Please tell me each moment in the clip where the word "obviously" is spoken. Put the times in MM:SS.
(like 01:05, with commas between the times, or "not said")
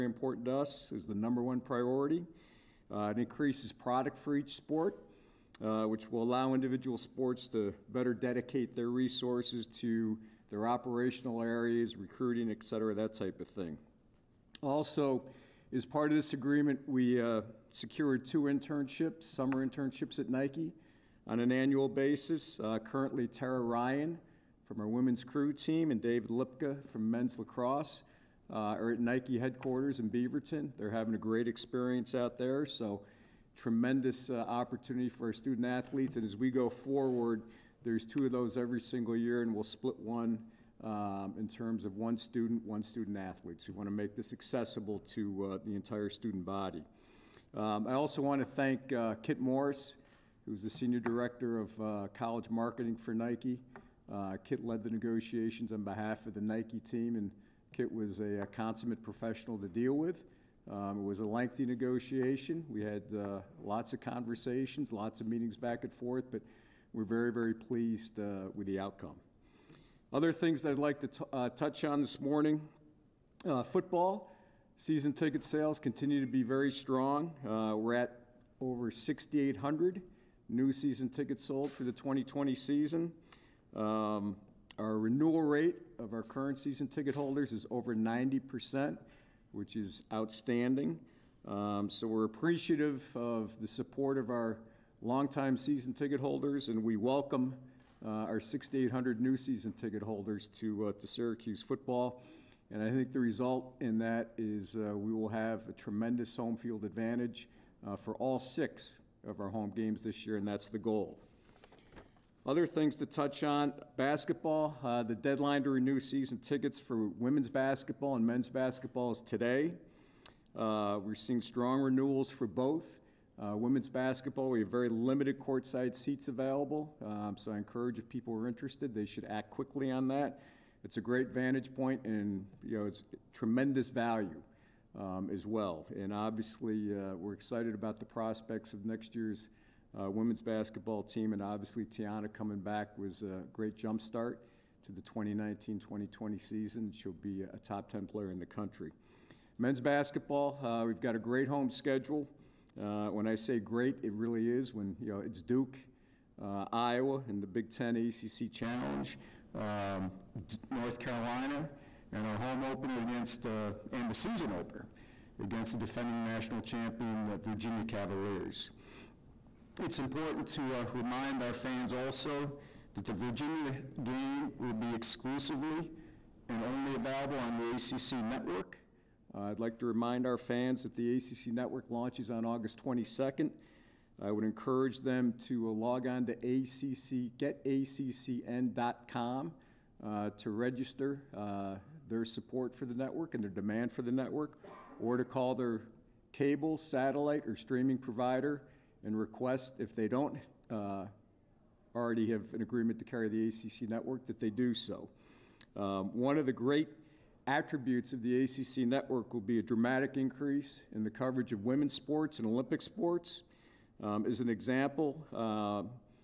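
02:16, 02:21.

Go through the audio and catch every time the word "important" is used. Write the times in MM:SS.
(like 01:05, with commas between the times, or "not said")
00:00, 02:50.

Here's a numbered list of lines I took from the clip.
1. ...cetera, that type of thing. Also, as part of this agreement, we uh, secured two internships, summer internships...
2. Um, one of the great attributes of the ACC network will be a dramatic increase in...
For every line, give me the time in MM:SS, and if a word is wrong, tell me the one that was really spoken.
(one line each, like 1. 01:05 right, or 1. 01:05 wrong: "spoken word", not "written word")
1. 00:12 right
2. 03:25 right.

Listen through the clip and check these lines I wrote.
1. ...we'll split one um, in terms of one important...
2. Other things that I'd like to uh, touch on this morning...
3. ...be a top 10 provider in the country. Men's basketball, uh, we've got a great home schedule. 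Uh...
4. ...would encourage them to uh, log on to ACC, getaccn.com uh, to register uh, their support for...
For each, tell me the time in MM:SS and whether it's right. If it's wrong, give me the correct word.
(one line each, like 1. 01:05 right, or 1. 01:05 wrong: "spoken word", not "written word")
1. 00:39 wrong: "student", not "important"
2. 01:10 right
3. 02:27 wrong: "player", not "provider"
4. 03:04 right.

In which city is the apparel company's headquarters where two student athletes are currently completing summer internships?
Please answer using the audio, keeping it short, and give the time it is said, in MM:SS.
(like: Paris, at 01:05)
Beaverton, at 00:30.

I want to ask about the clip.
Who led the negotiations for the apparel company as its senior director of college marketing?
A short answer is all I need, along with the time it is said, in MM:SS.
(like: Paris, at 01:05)
Kit Morris, at 00:49.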